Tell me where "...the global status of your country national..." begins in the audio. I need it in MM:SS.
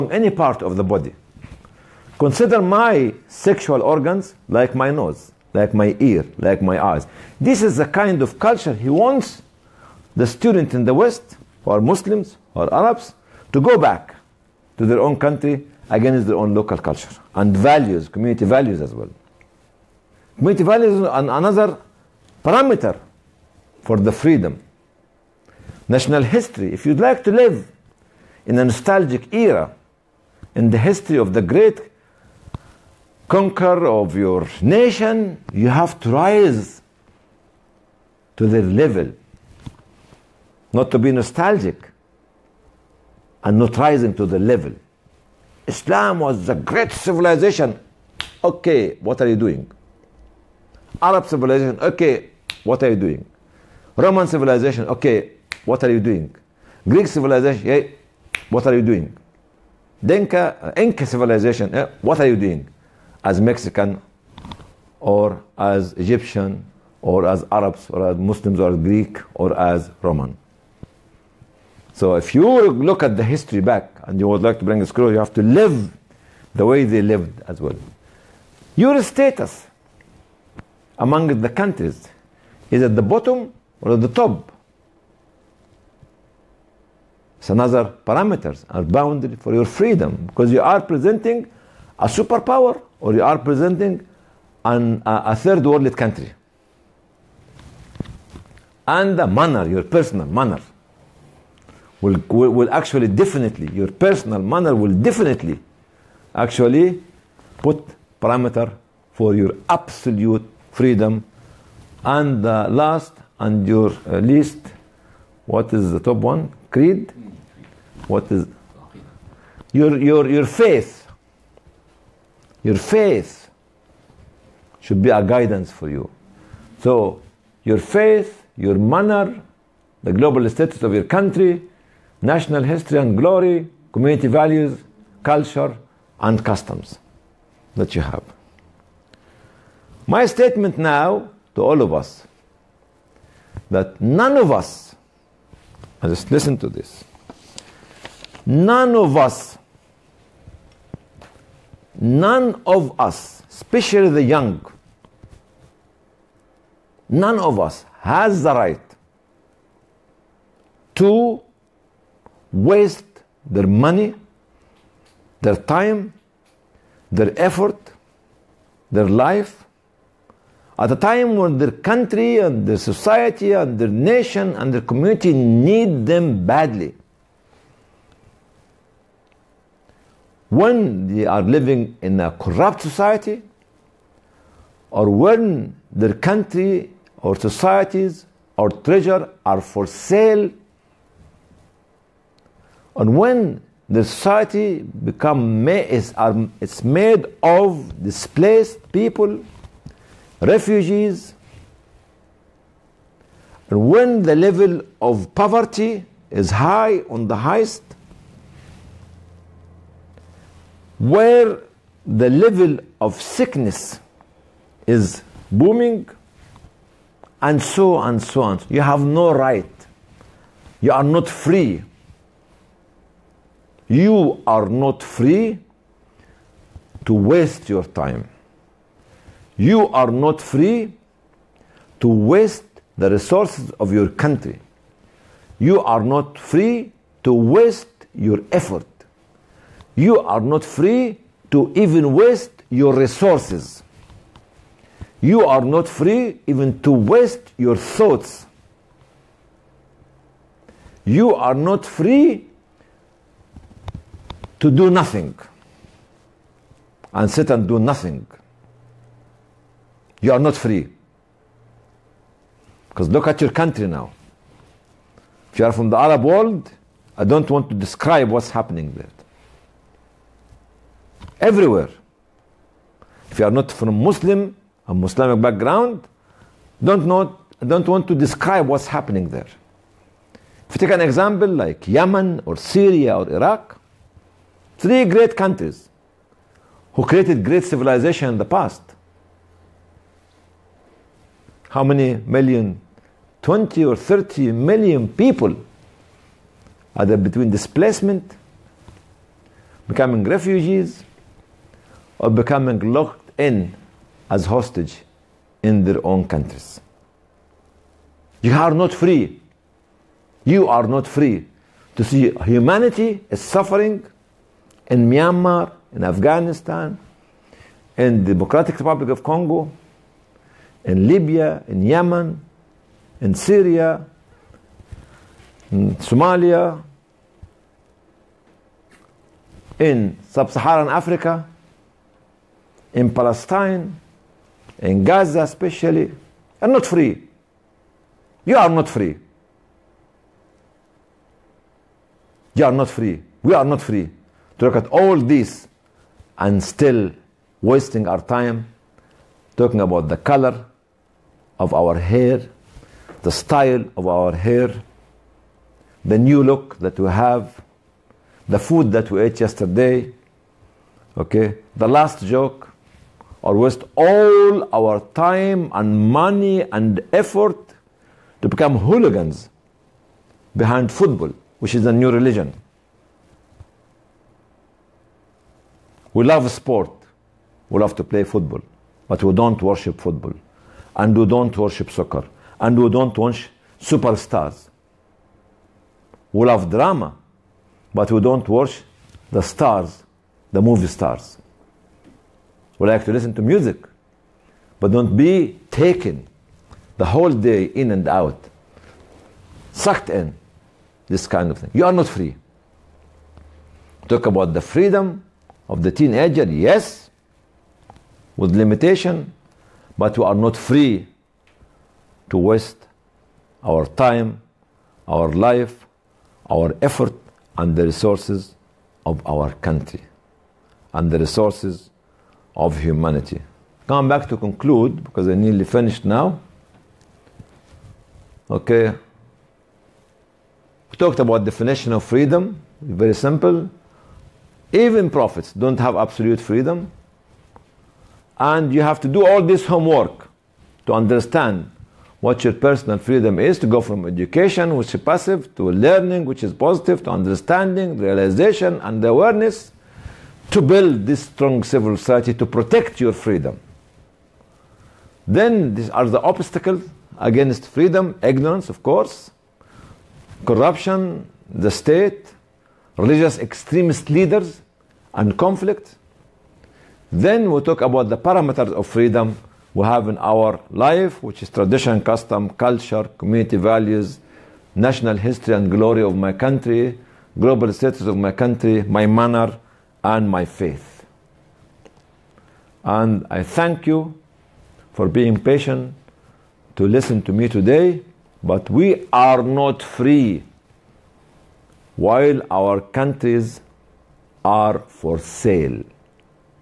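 02:10.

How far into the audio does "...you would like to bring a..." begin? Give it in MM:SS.
01:14.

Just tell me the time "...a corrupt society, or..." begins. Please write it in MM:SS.
03:02.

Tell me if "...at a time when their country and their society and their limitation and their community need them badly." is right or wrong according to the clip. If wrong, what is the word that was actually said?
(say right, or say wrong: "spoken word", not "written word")
wrong: "nation", not "limitation".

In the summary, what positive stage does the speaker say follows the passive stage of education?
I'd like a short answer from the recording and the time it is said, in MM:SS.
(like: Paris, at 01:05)
learning, at 07:25.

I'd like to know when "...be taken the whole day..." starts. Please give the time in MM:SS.
06:35.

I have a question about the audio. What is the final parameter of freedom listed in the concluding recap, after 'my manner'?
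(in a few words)
my faith.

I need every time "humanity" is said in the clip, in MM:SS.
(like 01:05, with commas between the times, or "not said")
05:12, 07:02.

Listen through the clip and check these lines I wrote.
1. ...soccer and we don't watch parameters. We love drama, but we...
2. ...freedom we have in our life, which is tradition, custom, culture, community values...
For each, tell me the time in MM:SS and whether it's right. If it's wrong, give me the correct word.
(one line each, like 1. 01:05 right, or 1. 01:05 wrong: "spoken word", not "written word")
1. 06:21 wrong: "superstars", not "parameters"
2. 07:48 right.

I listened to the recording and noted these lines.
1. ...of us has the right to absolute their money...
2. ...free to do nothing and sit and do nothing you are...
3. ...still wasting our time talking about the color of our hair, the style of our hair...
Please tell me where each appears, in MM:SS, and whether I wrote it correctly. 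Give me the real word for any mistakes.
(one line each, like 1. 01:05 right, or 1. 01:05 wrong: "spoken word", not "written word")
1. 02:37 wrong: "waste", not "absolute"
2. 04:11 right
3. 05:46 right.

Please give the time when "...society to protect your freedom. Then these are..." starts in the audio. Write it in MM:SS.
07:31.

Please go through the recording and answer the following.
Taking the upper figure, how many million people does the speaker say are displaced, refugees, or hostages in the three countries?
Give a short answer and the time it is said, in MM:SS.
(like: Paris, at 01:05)
30 million, at 04:53.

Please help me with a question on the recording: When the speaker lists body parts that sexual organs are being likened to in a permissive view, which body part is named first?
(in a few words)
nose.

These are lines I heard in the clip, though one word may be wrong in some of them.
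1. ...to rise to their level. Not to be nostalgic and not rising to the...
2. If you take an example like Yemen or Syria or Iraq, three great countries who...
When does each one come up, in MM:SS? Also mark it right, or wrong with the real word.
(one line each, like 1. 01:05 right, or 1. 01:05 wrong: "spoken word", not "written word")
1. 00:35 right
2. 04:40 right.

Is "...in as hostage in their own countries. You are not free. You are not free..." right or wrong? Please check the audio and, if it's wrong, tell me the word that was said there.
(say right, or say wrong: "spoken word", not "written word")
right.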